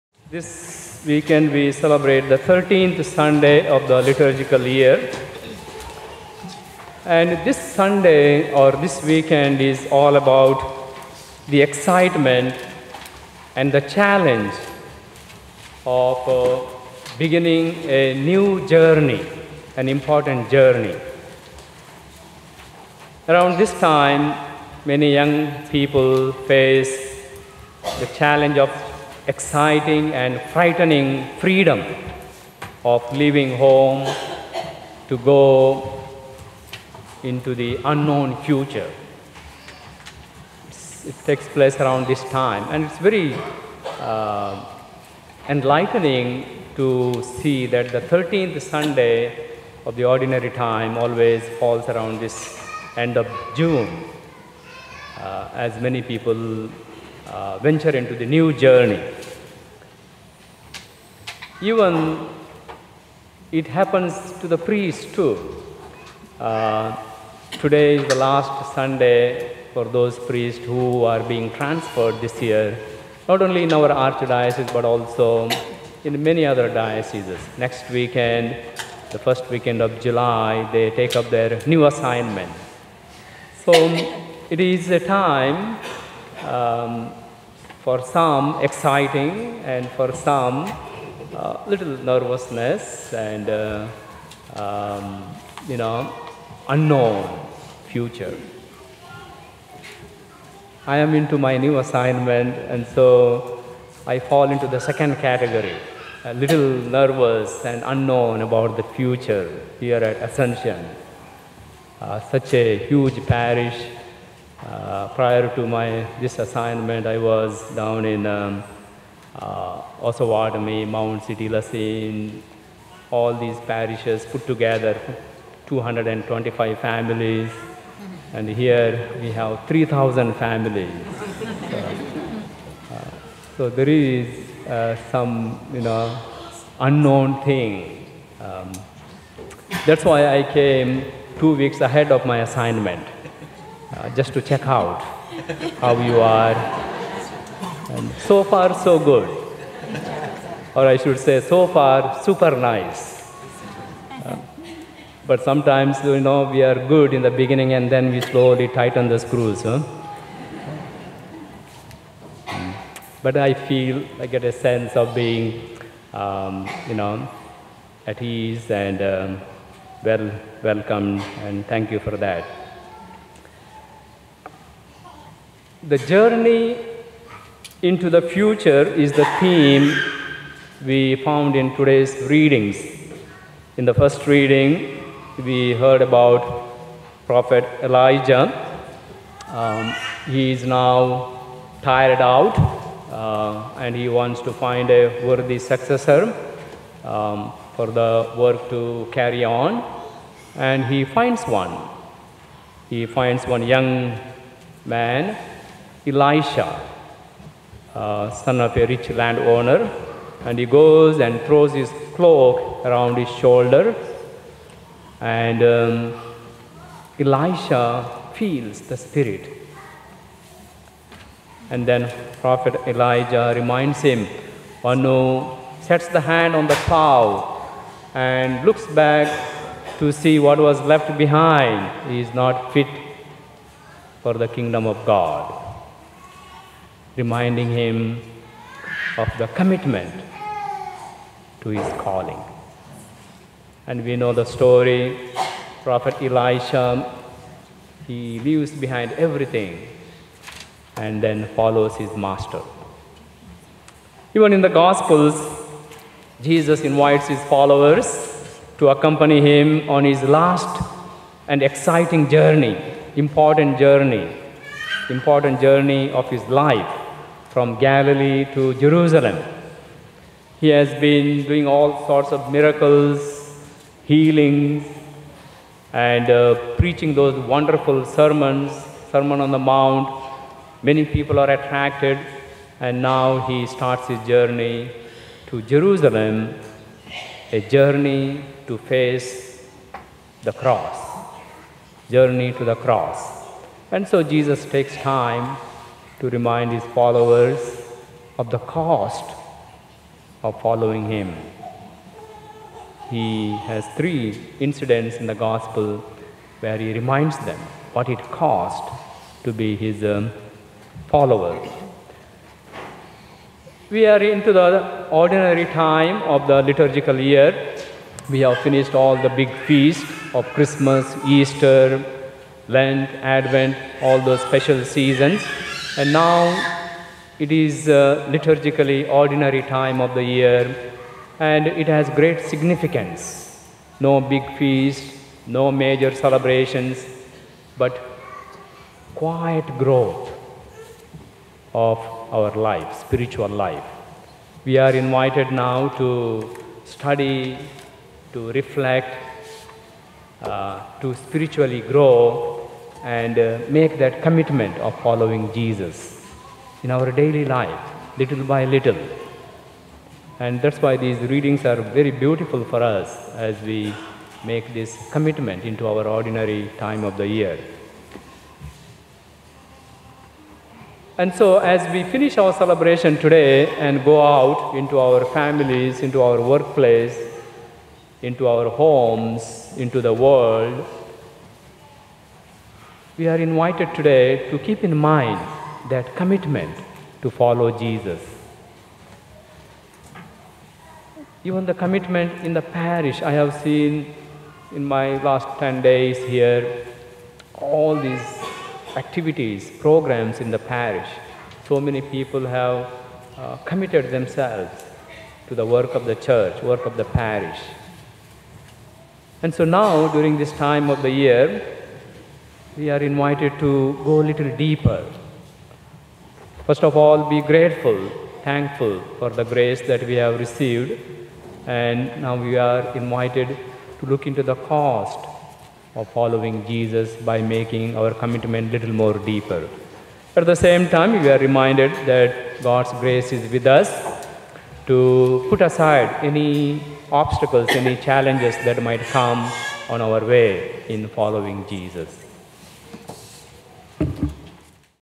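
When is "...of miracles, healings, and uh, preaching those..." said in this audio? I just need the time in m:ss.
4:32.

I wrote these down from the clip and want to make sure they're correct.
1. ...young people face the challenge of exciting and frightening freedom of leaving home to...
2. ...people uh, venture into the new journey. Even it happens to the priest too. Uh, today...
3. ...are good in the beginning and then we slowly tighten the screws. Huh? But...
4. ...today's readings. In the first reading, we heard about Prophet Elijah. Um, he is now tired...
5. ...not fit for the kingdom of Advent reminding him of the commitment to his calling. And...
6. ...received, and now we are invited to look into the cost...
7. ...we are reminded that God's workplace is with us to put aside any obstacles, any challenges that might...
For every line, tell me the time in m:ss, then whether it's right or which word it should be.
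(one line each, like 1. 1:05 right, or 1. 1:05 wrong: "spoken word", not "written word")
1. 0:25 right
2. 0:56 right
3. 2:36 right
4. 3:01 right
5. 3:52 wrong: "God", not "Advent"
6. 7:00 right
7. 7:11 wrong: "grace", not "workplace".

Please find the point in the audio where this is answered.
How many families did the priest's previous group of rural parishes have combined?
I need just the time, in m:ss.
2:05.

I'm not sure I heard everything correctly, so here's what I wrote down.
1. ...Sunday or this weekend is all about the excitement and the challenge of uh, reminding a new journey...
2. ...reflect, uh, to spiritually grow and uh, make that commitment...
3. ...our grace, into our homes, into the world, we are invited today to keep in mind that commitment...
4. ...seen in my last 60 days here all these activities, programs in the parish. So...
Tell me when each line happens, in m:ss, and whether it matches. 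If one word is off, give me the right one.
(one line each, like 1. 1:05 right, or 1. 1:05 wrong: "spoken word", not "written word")
1. 0:07 wrong: "beginning", not "reminding"
2. 5:48 right
3. 6:16 wrong: "workplace", not "grace"
4. 6:33 wrong: "10", not "60".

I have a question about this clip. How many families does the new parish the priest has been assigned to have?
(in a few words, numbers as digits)
3,000.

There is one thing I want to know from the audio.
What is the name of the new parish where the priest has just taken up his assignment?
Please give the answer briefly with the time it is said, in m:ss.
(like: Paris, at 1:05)
Ascension, at 1:50.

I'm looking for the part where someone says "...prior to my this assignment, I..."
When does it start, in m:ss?
1:55.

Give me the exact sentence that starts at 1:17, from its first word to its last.
Next weekend, the first weekend of July, they take up their new assignment.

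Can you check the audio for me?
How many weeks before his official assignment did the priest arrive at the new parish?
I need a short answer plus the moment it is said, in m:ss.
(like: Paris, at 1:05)
2, at 2:21.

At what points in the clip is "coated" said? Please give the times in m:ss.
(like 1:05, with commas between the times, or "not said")
not said.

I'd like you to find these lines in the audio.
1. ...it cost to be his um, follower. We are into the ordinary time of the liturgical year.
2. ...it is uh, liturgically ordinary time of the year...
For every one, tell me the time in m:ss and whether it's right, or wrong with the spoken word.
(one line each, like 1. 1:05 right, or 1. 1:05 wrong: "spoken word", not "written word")
1. 5:08 right
2. 5:27 right.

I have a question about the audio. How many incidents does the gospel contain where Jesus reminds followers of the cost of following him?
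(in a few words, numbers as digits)
3.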